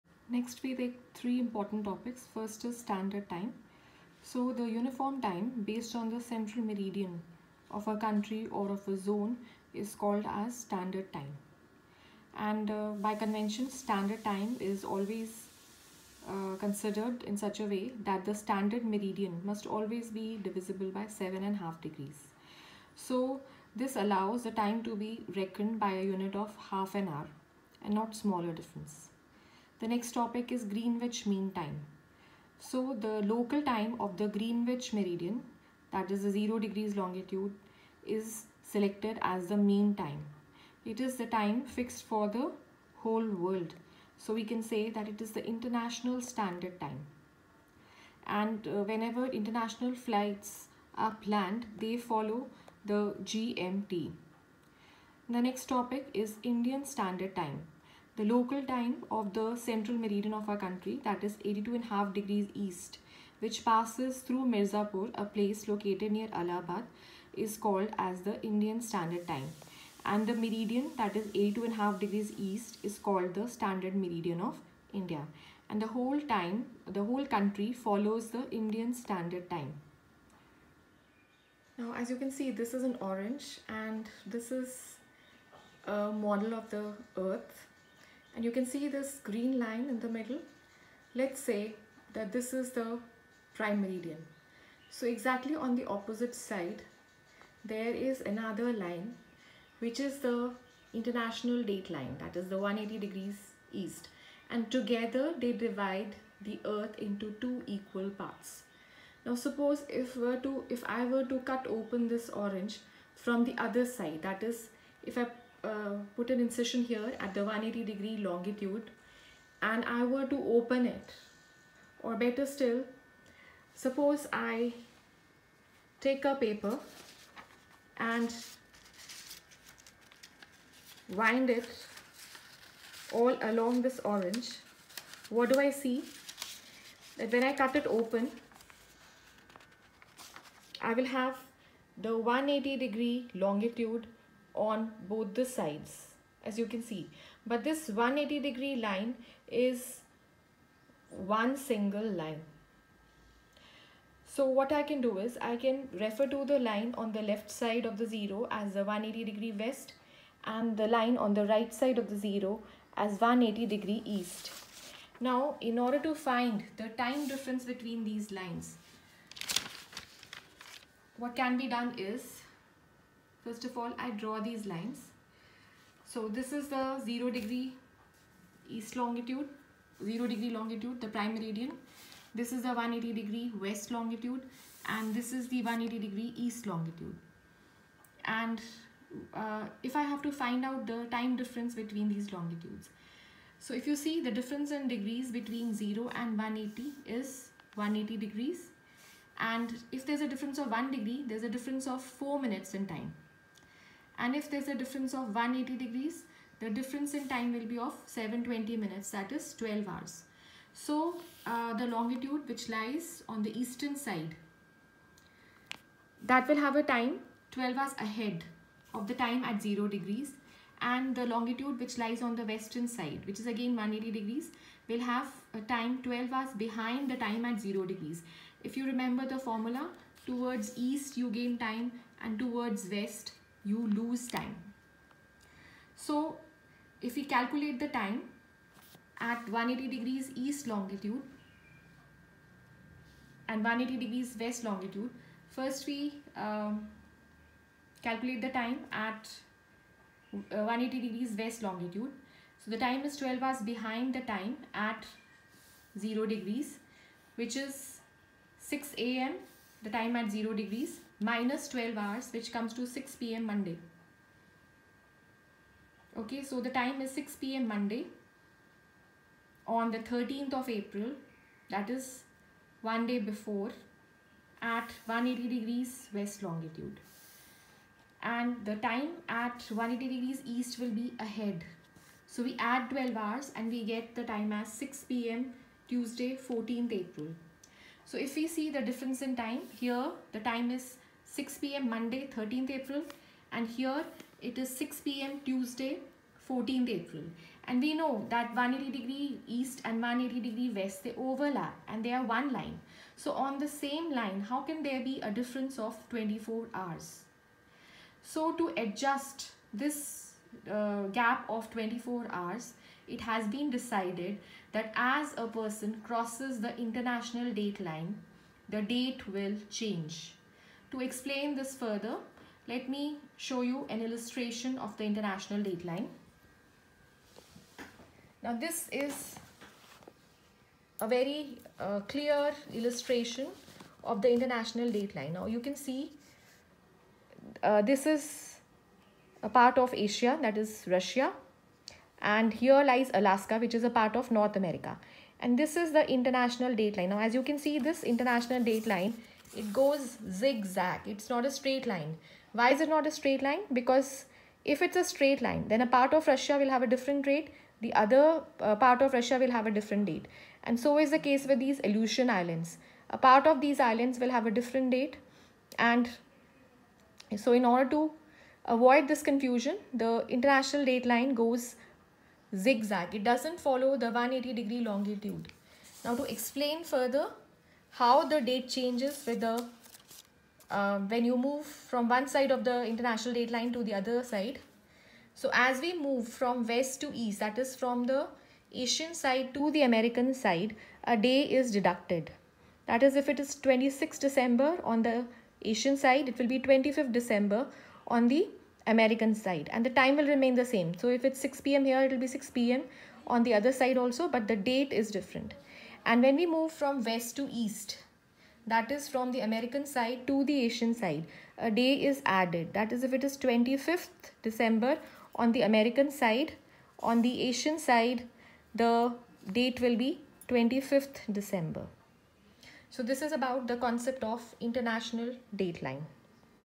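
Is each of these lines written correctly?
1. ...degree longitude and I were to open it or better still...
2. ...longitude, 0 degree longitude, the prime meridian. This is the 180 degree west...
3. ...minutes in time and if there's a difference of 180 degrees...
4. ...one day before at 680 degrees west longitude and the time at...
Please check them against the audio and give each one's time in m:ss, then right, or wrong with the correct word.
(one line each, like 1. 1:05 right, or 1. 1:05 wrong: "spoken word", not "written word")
1. 1:57 right
2. 2:58 right
3. 3:22 right
4. 4:32 wrong: "180", not "680".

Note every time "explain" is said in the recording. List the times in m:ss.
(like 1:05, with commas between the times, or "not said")
5:20, 6:16.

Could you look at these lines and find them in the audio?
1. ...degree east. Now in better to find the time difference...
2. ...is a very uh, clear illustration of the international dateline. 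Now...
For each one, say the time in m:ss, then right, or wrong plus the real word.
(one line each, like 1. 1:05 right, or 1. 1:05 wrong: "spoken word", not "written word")
1. 2:43 wrong: "order", not "better"
2. 5:28 right.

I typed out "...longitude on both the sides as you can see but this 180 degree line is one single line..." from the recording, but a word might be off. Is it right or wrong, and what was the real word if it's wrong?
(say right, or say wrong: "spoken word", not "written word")
right.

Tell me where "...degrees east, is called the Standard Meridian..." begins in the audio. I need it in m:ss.
1:11.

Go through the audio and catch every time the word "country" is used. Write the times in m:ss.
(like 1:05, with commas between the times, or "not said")
0:07, 1:00, 1:17.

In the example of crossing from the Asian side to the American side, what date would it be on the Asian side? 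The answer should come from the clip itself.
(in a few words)
26 December.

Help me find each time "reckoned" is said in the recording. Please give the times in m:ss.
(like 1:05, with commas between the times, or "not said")
0:25.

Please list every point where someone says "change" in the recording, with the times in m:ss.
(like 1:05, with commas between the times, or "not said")
5:19, 6:18.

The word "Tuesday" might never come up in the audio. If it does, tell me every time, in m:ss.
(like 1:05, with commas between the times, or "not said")
4:45, 4:55.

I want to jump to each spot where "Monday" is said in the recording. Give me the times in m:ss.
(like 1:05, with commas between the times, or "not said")
4:23, 4:27, 4:51.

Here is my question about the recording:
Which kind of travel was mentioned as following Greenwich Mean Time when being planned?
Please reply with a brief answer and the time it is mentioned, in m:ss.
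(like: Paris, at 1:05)
International flights, at 0:49.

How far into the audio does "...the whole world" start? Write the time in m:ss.
0:42.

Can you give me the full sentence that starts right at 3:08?
And uh, if I have to find out the time difference between these longitudes.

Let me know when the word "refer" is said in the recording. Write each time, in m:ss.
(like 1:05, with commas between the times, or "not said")
2:35.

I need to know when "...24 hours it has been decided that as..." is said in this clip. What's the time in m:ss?
5:11.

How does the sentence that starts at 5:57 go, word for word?
The other uh, part of Russia will have a different date.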